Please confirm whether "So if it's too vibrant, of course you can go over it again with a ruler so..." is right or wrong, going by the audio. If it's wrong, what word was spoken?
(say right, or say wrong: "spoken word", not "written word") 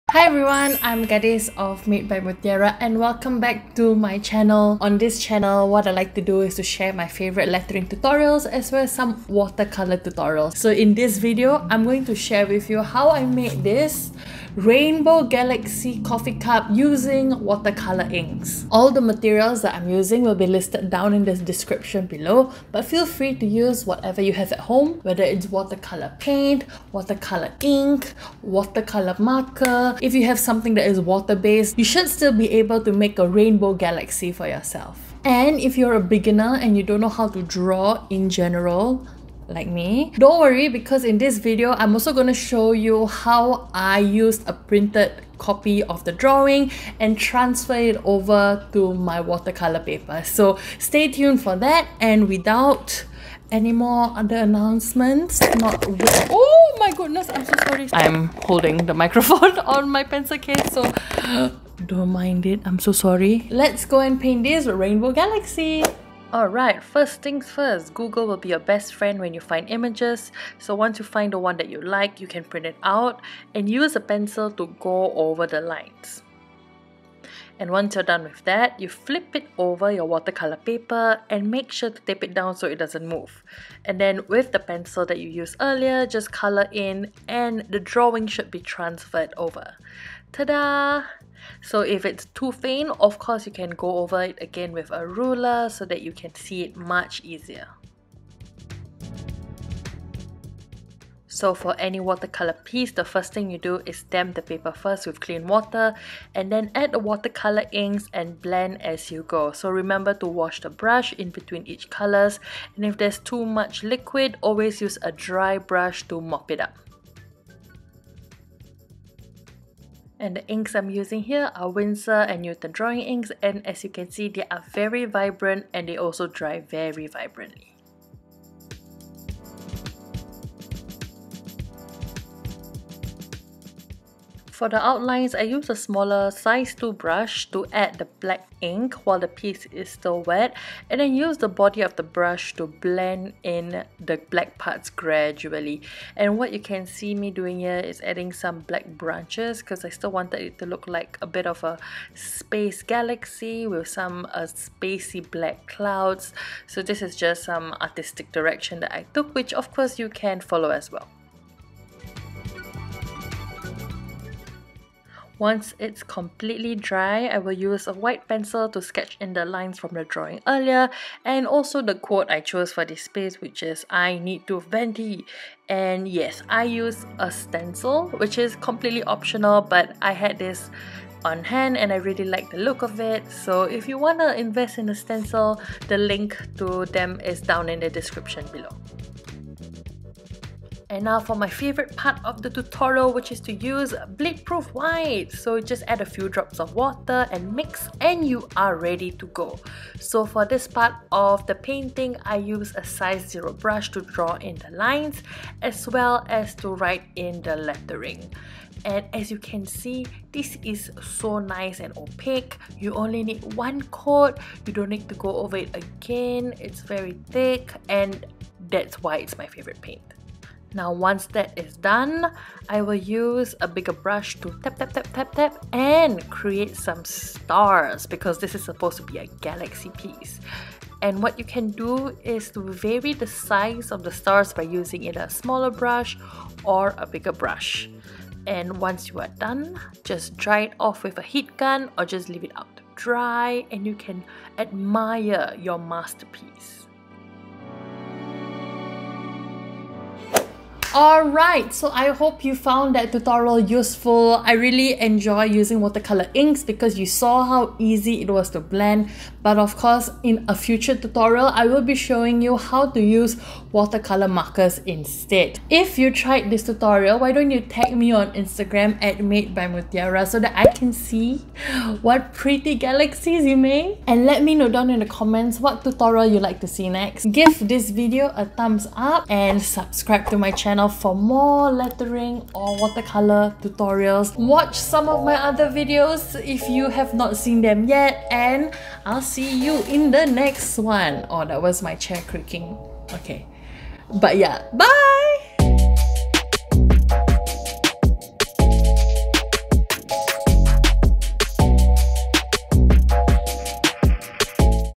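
wrong: "faint", not "vibrant".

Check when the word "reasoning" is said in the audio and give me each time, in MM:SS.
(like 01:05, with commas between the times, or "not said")
not said.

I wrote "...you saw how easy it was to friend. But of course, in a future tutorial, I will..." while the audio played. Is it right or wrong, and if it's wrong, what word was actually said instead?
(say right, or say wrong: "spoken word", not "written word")
wrong: "blend", not "friend".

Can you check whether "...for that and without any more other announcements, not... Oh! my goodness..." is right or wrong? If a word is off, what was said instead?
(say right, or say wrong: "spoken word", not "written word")
right.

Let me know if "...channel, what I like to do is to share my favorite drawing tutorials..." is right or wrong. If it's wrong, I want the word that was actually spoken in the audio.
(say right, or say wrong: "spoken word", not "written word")
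wrong: "lettering", not "drawing".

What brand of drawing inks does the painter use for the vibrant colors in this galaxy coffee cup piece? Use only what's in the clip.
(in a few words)
Winsor and Newton.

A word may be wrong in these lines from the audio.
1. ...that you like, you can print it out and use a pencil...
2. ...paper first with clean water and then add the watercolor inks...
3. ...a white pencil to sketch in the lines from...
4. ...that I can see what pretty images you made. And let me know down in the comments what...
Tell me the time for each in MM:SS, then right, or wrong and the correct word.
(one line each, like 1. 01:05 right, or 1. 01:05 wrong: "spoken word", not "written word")
1. 01:11 right
2. 01:44 right
3. 02:47 right
4. 04:30 wrong: "galaxies", not "images".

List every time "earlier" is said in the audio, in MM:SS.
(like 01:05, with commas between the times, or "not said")
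01:25, 02:50.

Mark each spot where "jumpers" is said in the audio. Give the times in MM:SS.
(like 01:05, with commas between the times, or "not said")
not said.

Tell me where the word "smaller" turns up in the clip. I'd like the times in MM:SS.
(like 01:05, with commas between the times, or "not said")
02:15, 03:55.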